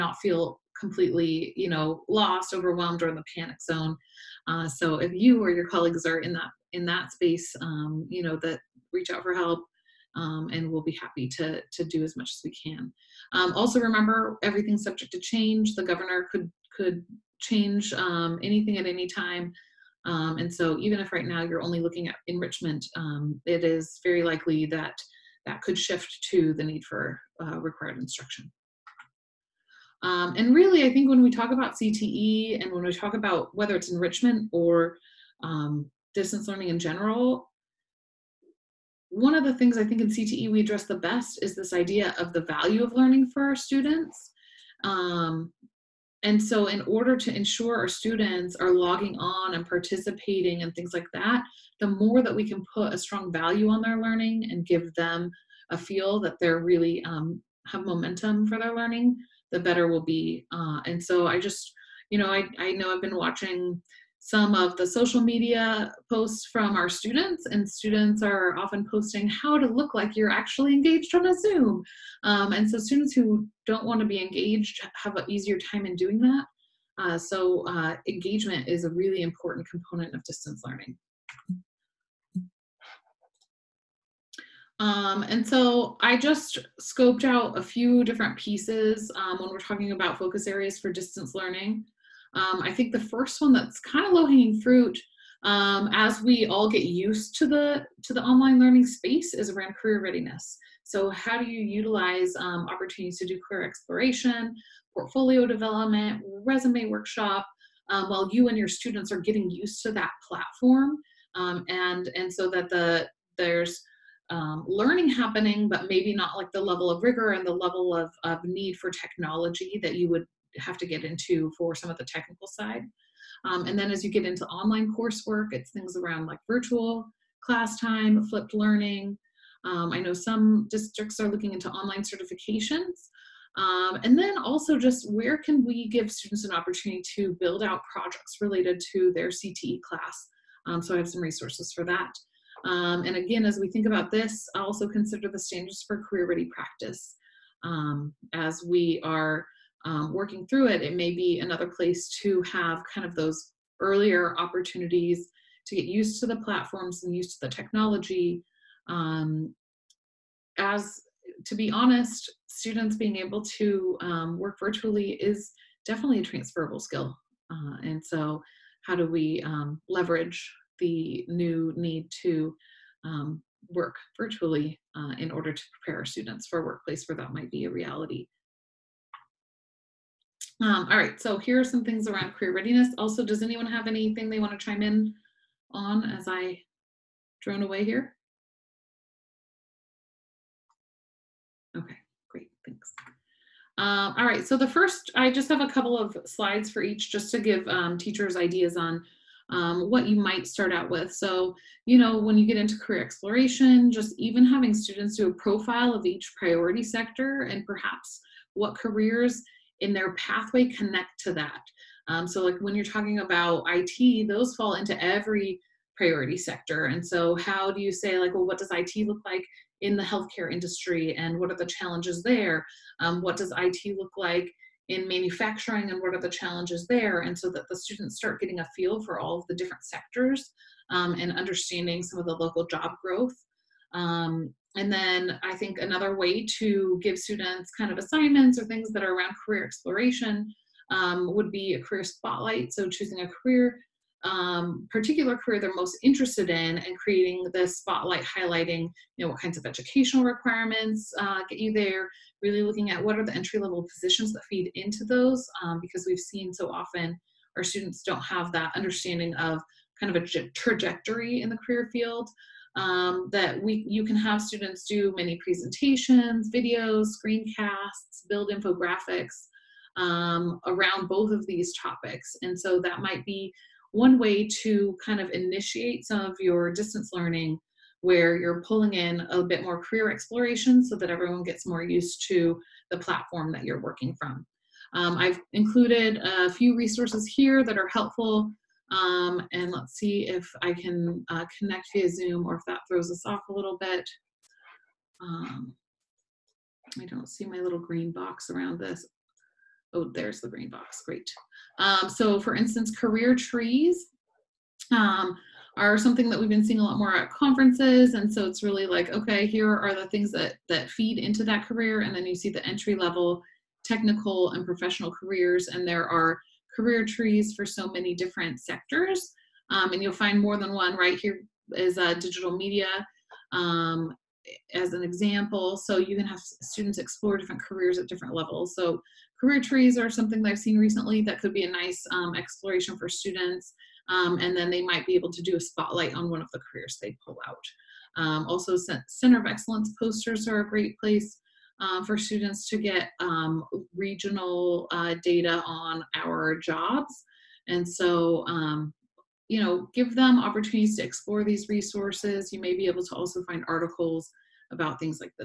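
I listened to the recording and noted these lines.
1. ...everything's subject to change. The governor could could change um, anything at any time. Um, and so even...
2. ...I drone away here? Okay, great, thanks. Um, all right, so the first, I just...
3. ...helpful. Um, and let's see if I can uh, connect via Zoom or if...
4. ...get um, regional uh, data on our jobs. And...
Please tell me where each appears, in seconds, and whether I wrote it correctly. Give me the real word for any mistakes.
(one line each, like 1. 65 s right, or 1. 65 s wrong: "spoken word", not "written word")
1. 14 s right
2. 186 s right
3. 287 s right
4. 342 s right.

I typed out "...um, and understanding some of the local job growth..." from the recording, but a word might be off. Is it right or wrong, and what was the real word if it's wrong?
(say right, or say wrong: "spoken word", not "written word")
right.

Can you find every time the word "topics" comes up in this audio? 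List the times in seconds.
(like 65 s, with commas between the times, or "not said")
271 s.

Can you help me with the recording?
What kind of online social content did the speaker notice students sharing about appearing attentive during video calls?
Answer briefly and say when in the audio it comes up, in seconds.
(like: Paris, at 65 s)
Social media posts, at 64 s.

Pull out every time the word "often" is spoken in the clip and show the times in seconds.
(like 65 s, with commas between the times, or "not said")
68 s, 256 s.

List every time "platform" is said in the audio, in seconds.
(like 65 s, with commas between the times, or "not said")
110 s, 156 s, 282 s.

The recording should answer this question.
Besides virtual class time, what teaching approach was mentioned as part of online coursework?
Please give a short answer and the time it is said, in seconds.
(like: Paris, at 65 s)
Flipped learning, at 128 s.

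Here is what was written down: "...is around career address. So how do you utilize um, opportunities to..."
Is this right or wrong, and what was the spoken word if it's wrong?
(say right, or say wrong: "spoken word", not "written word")
wrong: "readiness", not "address".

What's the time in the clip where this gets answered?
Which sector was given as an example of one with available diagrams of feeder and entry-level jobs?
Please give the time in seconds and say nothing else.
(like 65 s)
322 s.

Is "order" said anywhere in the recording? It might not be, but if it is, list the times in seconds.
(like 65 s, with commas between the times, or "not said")
46 s, 175 s.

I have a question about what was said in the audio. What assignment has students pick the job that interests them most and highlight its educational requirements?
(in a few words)
Career spotlight.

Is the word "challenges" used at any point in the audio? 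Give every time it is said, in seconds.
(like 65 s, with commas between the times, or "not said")
221 s, 226 s.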